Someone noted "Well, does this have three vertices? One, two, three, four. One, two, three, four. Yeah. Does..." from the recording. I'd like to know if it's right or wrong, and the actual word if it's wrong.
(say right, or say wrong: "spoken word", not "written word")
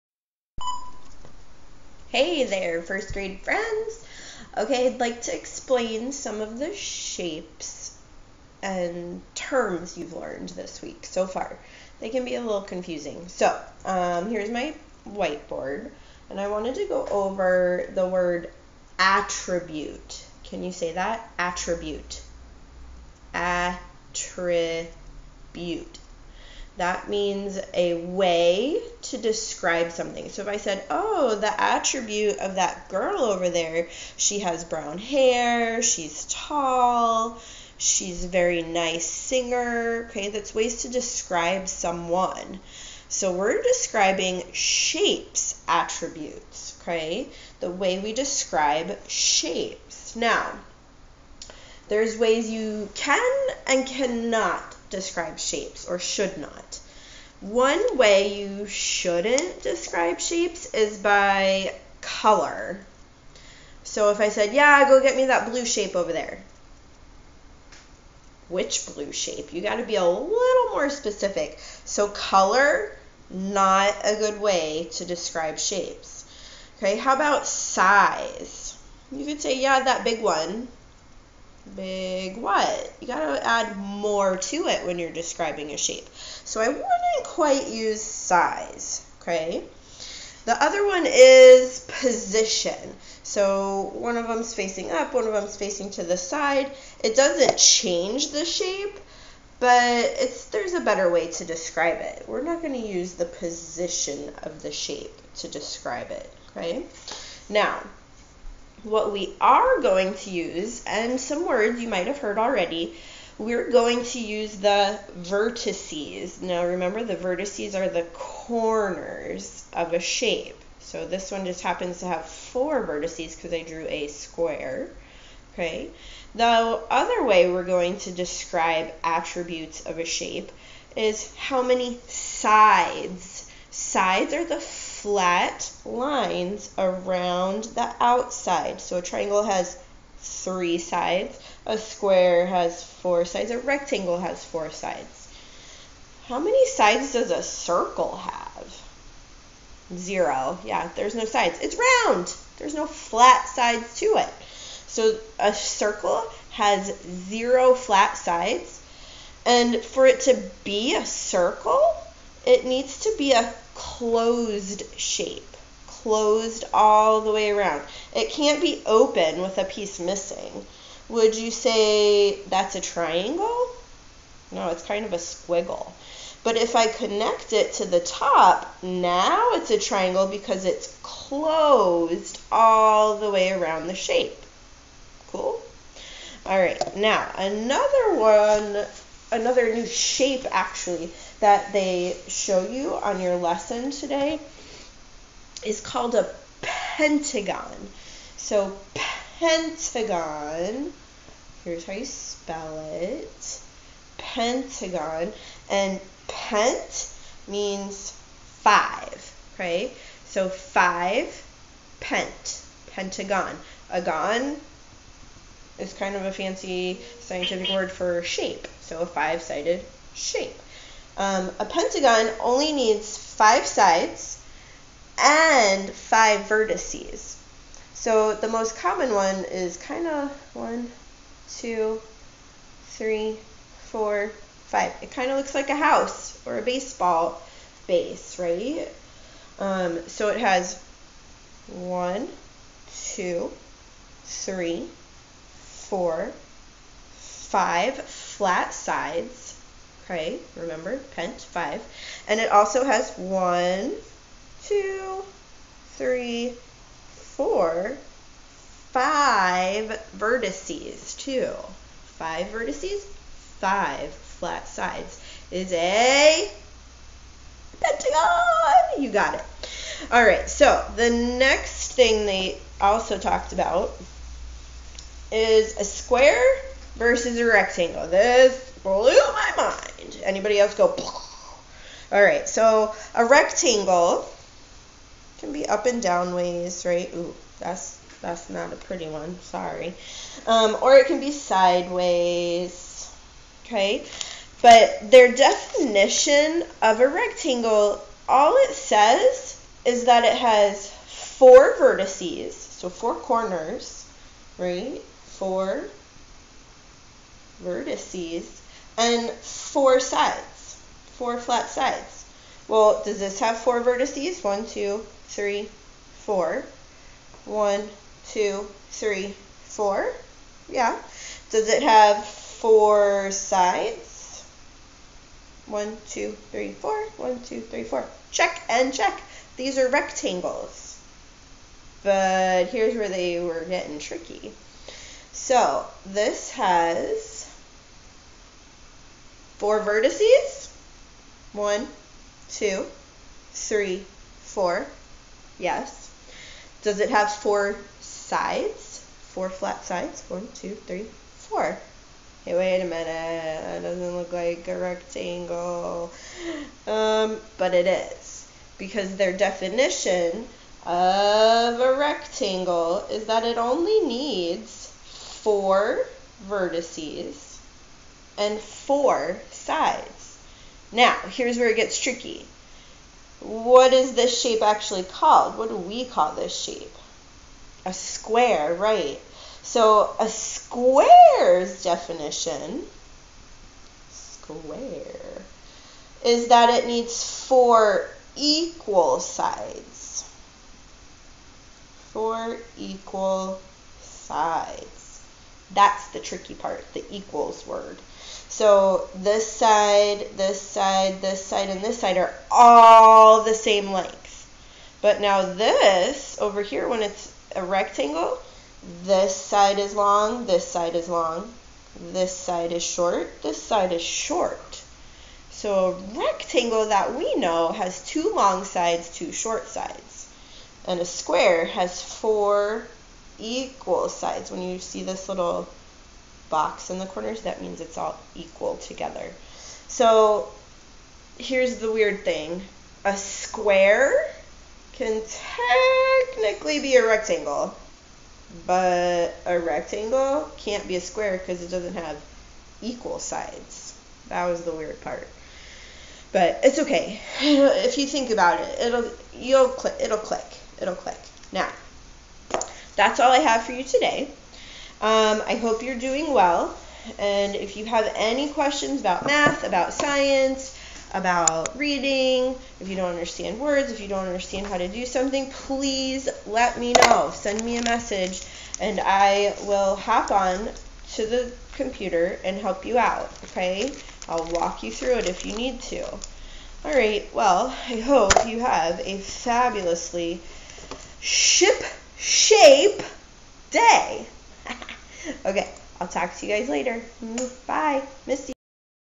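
wrong: "four", not "three".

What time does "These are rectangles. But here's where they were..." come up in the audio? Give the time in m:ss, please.
5:29.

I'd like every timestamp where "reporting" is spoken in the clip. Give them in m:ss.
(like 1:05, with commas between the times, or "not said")
not said.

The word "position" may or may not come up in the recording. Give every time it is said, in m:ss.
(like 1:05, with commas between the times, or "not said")
1:32, 1:43.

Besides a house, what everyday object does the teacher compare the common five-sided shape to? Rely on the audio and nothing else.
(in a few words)
a baseball base.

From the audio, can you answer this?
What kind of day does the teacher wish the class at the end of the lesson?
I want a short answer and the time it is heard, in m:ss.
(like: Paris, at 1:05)
fabulously ship shape, at 7:59.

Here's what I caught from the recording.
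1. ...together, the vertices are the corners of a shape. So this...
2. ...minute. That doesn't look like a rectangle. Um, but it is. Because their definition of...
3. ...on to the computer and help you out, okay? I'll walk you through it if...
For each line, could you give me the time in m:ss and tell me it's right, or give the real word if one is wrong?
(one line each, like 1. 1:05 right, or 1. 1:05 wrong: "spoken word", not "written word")
1. 1:56 wrong: "remember", not "together"
2. 5:52 right
3. 7:50 right.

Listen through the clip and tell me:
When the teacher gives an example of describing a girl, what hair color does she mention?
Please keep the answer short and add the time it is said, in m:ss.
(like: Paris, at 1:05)
brown, at 0:34.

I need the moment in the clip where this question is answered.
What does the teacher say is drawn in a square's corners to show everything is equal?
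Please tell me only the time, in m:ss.
7:05.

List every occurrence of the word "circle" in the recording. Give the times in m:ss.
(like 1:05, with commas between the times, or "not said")
2:27, 2:35, 2:41.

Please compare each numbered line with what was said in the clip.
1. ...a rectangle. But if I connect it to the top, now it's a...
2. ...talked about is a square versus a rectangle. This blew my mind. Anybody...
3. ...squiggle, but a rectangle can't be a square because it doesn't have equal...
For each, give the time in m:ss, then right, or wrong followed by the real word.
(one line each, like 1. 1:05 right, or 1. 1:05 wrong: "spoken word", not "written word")
1. 2:55 wrong: "squiggle", not "rectangle"
2. 4:33 right
3. 7:17 wrong: "rectangle", not "squiggle".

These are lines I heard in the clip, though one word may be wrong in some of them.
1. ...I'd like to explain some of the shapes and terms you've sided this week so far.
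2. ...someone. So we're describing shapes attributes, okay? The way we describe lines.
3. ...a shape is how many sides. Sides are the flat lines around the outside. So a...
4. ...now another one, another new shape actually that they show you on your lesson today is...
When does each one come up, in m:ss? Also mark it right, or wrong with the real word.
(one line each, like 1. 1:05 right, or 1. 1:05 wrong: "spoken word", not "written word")
1. 0:04 wrong: "learned", not "sided"
2. 0:41 wrong: "shapes", not "lines"
3. 2:09 right
4. 3:06 right.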